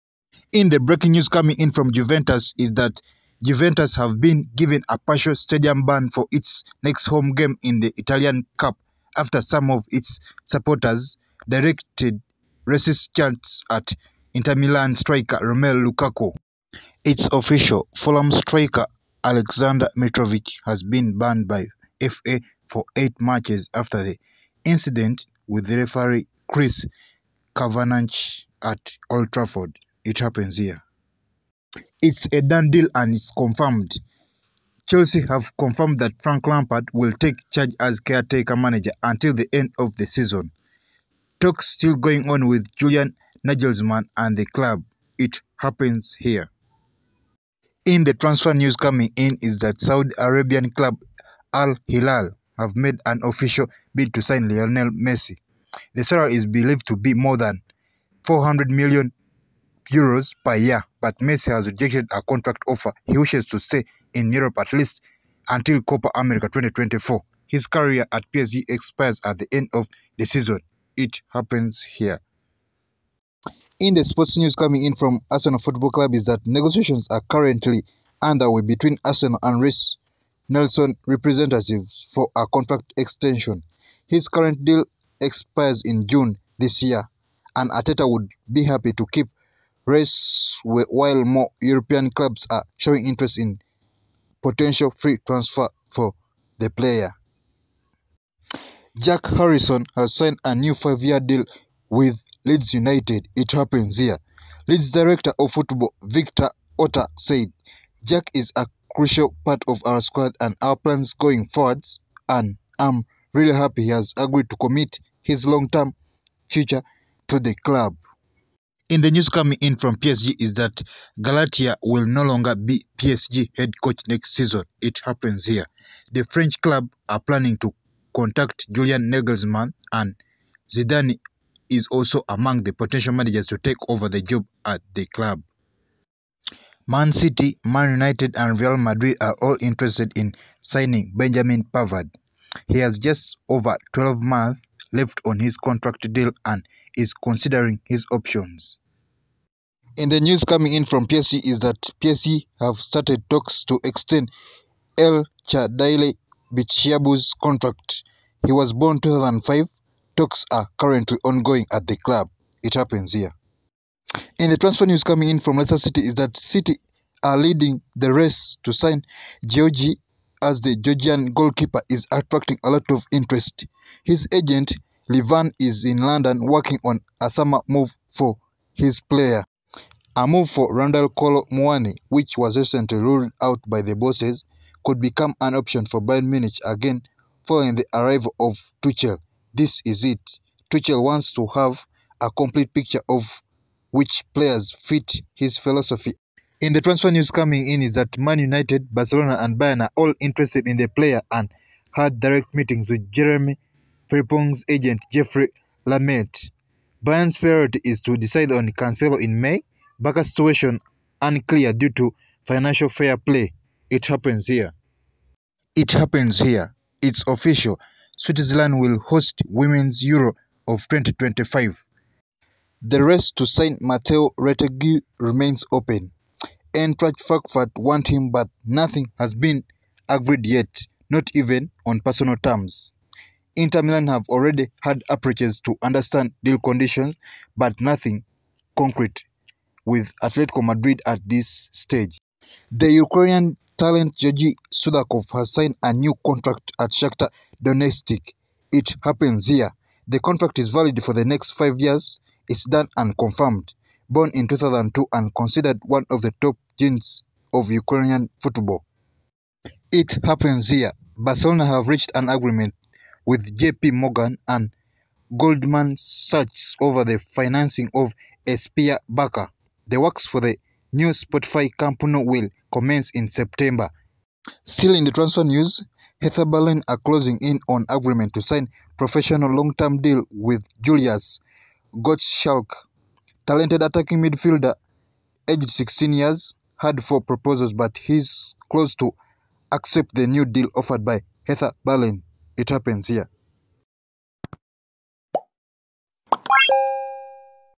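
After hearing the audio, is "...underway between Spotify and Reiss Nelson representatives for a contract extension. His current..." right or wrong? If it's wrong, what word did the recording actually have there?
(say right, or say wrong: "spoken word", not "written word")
wrong: "Arsenal", not "Spotify".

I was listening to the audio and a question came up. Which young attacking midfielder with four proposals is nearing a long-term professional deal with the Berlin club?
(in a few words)
Julius Gottschalk.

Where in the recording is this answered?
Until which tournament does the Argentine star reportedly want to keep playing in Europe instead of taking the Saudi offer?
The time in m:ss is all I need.
1:05.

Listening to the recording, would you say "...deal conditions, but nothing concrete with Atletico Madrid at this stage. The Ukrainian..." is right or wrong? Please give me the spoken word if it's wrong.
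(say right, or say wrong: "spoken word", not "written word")
right.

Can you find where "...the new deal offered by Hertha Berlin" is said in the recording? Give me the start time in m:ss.
4:50.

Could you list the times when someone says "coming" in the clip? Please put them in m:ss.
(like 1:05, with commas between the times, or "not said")
0:01, 0:48, 1:14, 1:59, 2:30, 2:45, 3:17.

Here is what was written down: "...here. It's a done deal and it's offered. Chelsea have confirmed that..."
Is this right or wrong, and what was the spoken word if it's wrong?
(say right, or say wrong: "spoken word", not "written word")
wrong: "confirmed", not "offered".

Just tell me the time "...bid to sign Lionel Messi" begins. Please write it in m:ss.
0:53.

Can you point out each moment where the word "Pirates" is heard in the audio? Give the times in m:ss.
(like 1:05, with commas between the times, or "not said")
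not said.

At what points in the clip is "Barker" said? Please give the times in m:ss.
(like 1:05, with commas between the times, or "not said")
3:30, 4:29.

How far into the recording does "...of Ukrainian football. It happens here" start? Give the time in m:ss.
4:17.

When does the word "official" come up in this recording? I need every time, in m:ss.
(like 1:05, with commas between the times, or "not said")
0:17, 0:53, 3:37.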